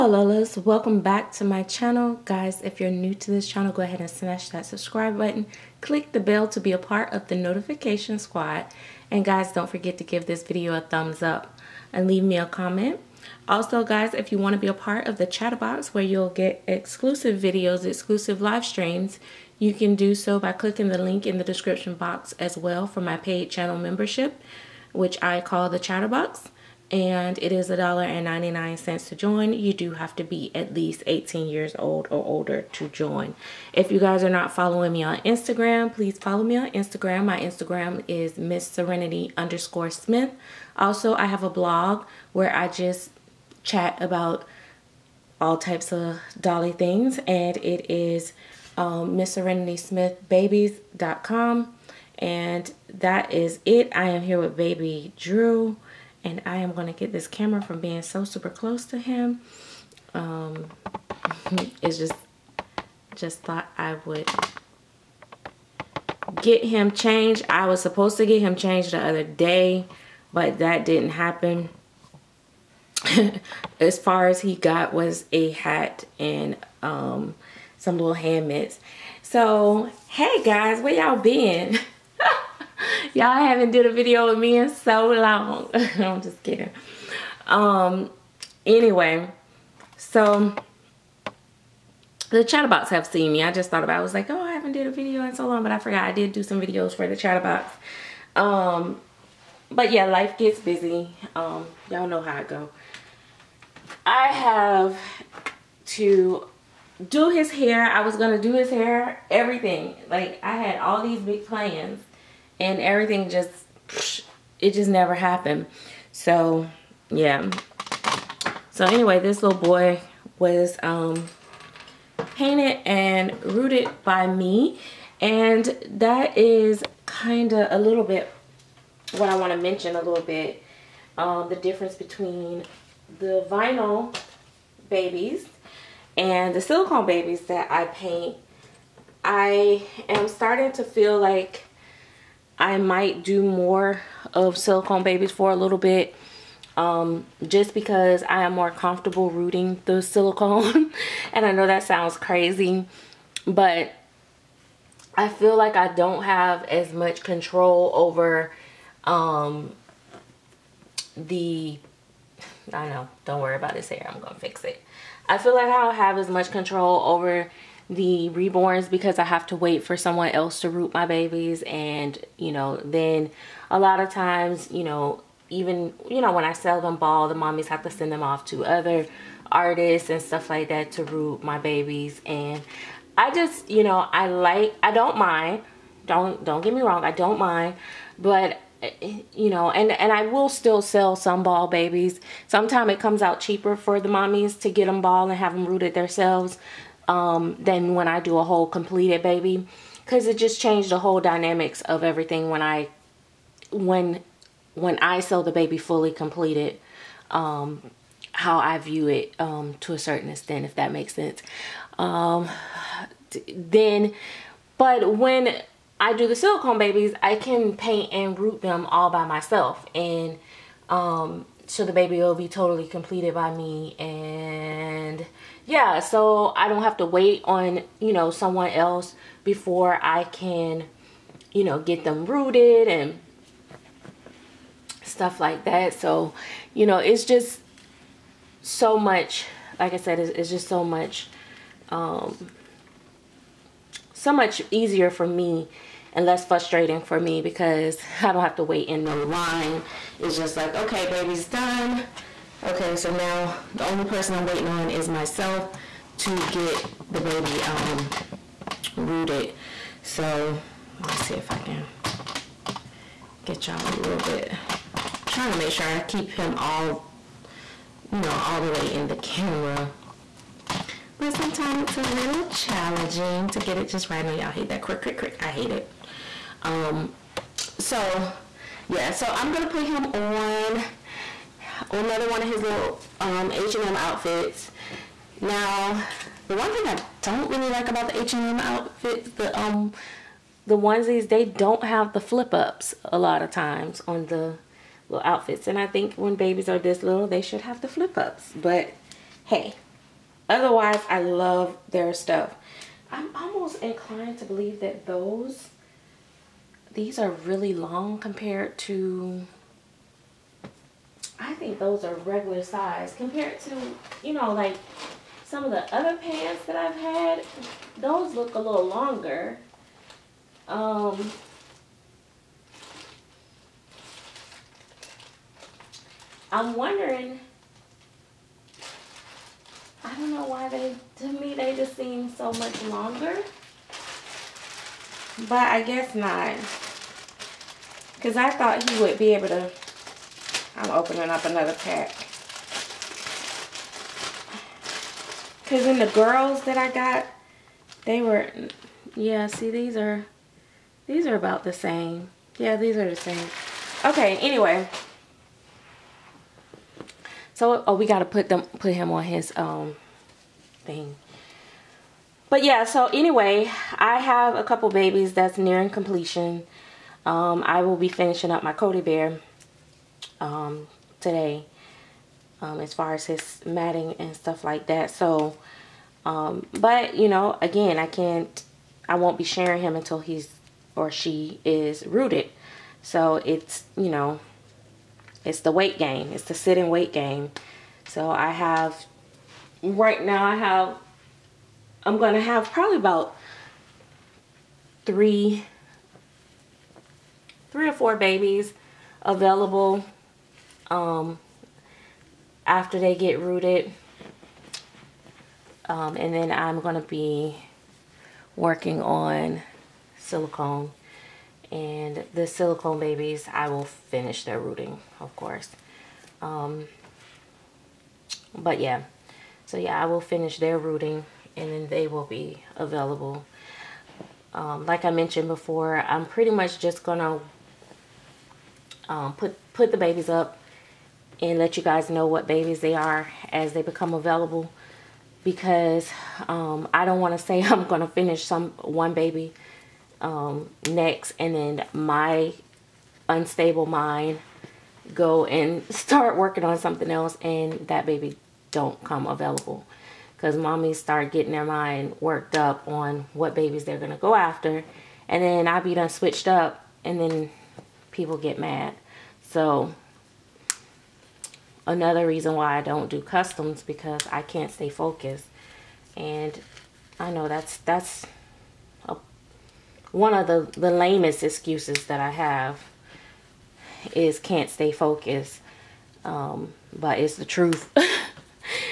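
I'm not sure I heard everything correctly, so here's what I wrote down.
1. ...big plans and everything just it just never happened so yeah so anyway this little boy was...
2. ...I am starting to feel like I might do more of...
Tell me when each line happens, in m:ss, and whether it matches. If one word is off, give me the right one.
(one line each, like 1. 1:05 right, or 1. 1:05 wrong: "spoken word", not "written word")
1. 1:51 right
2. 2:19 right.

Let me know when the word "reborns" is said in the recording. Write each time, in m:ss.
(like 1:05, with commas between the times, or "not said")
2:48.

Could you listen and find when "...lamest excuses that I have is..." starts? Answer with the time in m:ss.
7:50.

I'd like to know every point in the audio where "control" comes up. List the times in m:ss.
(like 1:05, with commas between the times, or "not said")
2:37, 2:46.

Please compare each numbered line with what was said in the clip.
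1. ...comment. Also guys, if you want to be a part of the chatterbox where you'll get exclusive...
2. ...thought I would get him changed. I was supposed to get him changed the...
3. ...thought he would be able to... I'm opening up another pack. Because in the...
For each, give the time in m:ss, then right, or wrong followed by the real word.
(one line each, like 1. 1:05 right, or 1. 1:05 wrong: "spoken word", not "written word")
1. 0:12 right
2. 1:03 right
3. 5:38 right.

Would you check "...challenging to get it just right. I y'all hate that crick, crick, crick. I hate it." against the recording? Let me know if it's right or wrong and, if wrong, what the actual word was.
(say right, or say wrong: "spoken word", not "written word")
right.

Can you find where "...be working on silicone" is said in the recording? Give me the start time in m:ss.
6:47.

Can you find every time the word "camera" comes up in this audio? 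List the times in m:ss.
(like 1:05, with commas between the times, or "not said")
0:57, 4:29.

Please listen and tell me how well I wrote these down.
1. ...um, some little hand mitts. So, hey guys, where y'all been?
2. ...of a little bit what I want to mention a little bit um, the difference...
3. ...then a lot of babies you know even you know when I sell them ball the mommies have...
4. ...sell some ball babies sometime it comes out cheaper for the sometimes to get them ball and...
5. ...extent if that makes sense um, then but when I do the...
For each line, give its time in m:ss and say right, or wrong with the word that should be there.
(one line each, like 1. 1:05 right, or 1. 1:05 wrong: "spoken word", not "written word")
1. 1:16 right
2. 2:07 right
3. 2:52 wrong: "times", not "babies"
4. 3:10 wrong: "mommies", not "sometimes"
5. 3:30 right.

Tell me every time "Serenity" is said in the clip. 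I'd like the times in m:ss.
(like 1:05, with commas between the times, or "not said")
0:38, 0:49.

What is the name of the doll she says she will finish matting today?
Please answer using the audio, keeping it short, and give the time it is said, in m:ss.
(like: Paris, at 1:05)
Cody Bear, at 6:08.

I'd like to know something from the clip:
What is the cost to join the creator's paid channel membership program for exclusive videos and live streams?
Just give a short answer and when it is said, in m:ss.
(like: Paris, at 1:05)
$1.99, at 0:27.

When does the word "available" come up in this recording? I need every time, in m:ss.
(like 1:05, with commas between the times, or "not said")
6:39, 7:02, 7:14, 7:29.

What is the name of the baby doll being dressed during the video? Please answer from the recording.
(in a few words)
Drew.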